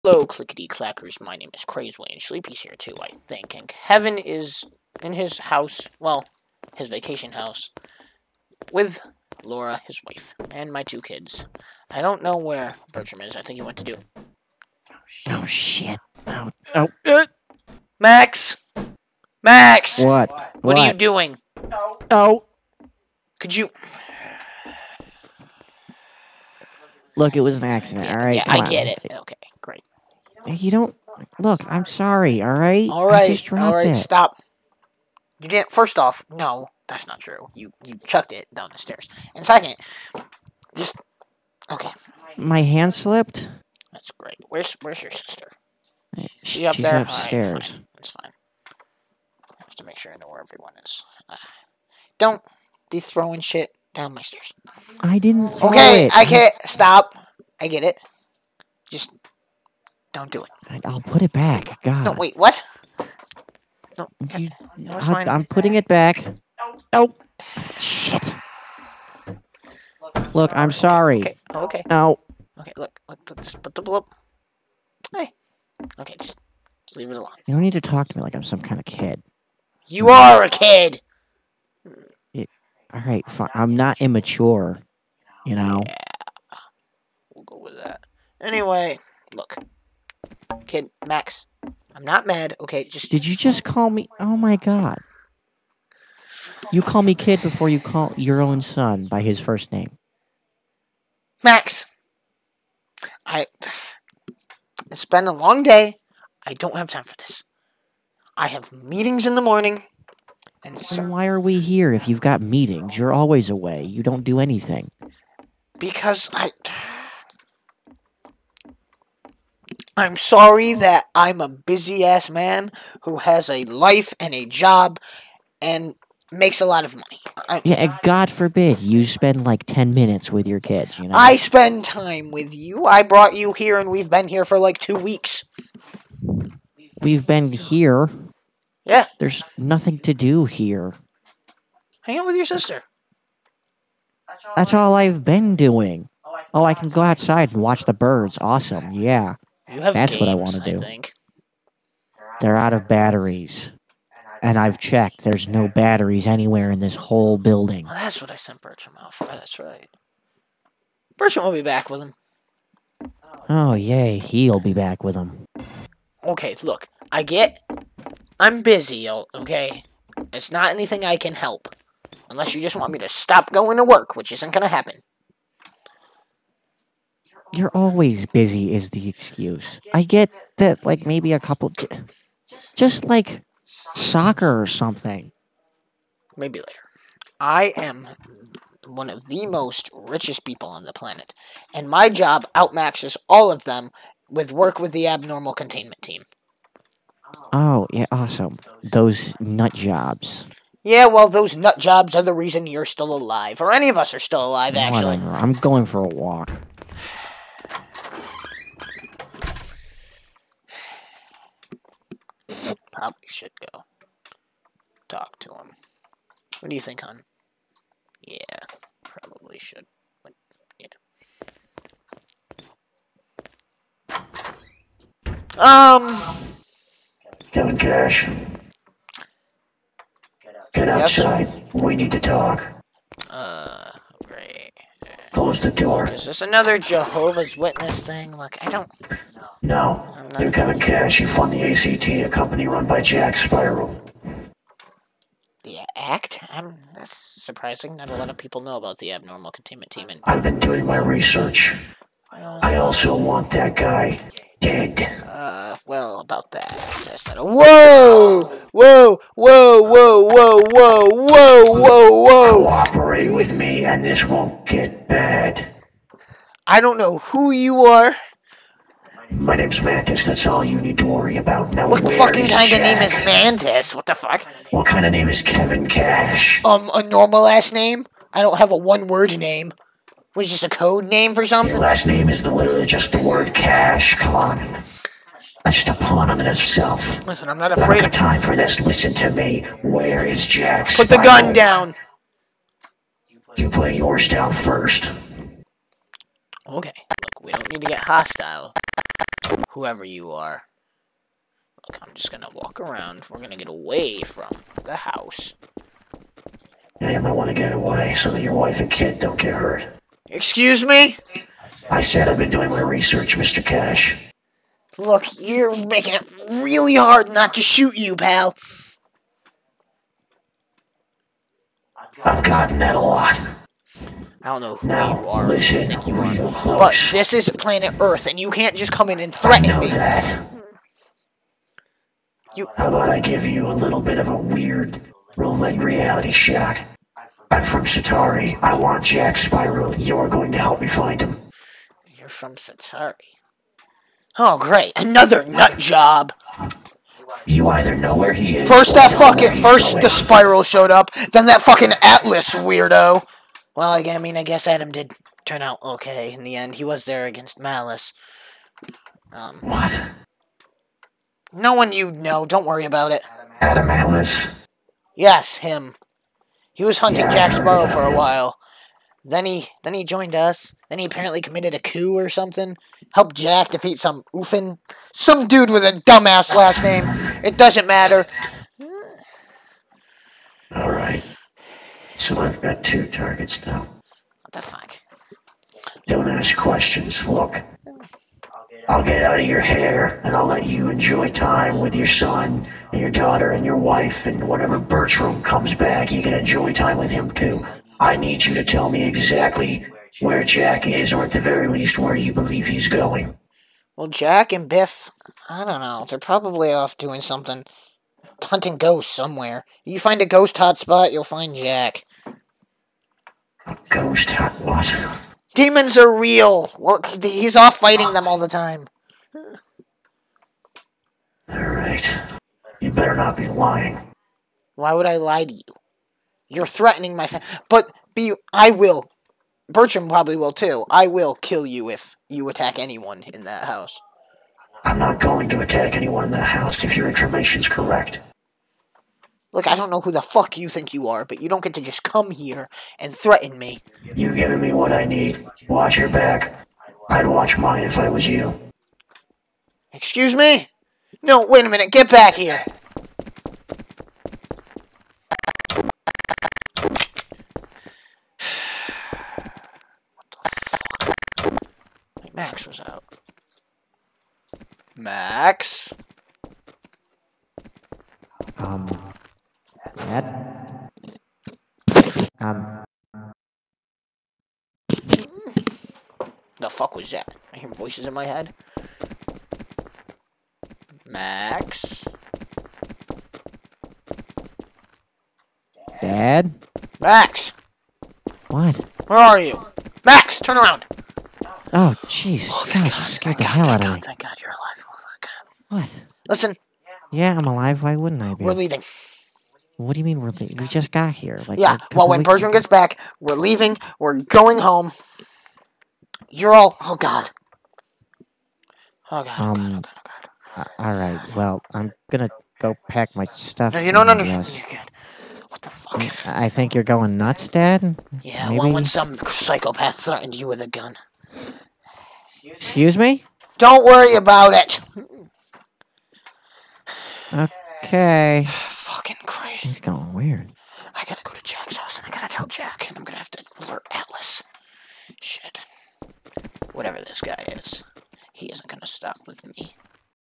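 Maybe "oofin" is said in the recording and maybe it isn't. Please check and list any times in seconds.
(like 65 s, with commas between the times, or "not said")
374 s.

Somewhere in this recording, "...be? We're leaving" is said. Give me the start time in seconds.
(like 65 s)
498 s.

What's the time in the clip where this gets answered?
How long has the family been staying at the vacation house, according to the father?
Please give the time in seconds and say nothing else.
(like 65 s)
134 s.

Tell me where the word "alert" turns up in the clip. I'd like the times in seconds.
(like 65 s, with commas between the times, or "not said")
533 s.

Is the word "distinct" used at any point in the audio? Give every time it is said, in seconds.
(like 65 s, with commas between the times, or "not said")
not said.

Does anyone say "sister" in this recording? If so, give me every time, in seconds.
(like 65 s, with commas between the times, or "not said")
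45 s, 142 s.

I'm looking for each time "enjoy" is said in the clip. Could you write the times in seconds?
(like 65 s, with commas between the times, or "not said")
390 s, 396 s.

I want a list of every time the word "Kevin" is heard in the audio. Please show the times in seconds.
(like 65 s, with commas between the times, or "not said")
3 s, 227 s, 240 s, 275 s.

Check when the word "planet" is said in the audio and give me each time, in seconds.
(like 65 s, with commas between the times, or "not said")
190 s, 327 s.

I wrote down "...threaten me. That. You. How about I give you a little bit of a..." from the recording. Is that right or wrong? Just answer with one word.
right.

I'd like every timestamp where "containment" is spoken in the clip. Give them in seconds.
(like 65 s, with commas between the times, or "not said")
195 s, 249 s.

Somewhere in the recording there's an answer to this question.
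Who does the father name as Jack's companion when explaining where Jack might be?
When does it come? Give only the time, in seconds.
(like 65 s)
404 s.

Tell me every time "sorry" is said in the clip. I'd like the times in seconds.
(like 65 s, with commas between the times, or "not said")
31 s, 70 s, 120 s.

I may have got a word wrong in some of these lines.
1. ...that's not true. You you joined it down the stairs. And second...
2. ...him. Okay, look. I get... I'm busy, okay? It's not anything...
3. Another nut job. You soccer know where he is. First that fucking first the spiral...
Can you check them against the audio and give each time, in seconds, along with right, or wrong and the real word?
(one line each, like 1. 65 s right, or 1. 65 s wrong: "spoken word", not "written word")
1. 36 s wrong: "chucked", not "joined"
2. 165 s right
3. 344 s wrong: "either", not "soccer".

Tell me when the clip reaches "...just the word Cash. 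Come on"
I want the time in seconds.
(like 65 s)
282 s.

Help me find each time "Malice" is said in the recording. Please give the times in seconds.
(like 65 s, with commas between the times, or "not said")
357 s, 363 s.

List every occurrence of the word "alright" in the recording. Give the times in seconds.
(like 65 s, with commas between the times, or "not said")
28 s, 421 s.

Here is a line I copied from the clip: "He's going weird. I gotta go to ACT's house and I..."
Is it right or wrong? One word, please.
wrong.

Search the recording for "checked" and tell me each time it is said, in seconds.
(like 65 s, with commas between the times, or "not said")
154 s.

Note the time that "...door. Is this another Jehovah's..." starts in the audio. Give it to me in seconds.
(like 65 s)
235 s.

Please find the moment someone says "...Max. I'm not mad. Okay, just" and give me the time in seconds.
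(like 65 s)
91 s.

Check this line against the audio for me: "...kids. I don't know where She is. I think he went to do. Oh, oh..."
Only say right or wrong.
wrong.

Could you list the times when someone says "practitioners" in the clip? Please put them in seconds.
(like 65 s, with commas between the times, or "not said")
not said.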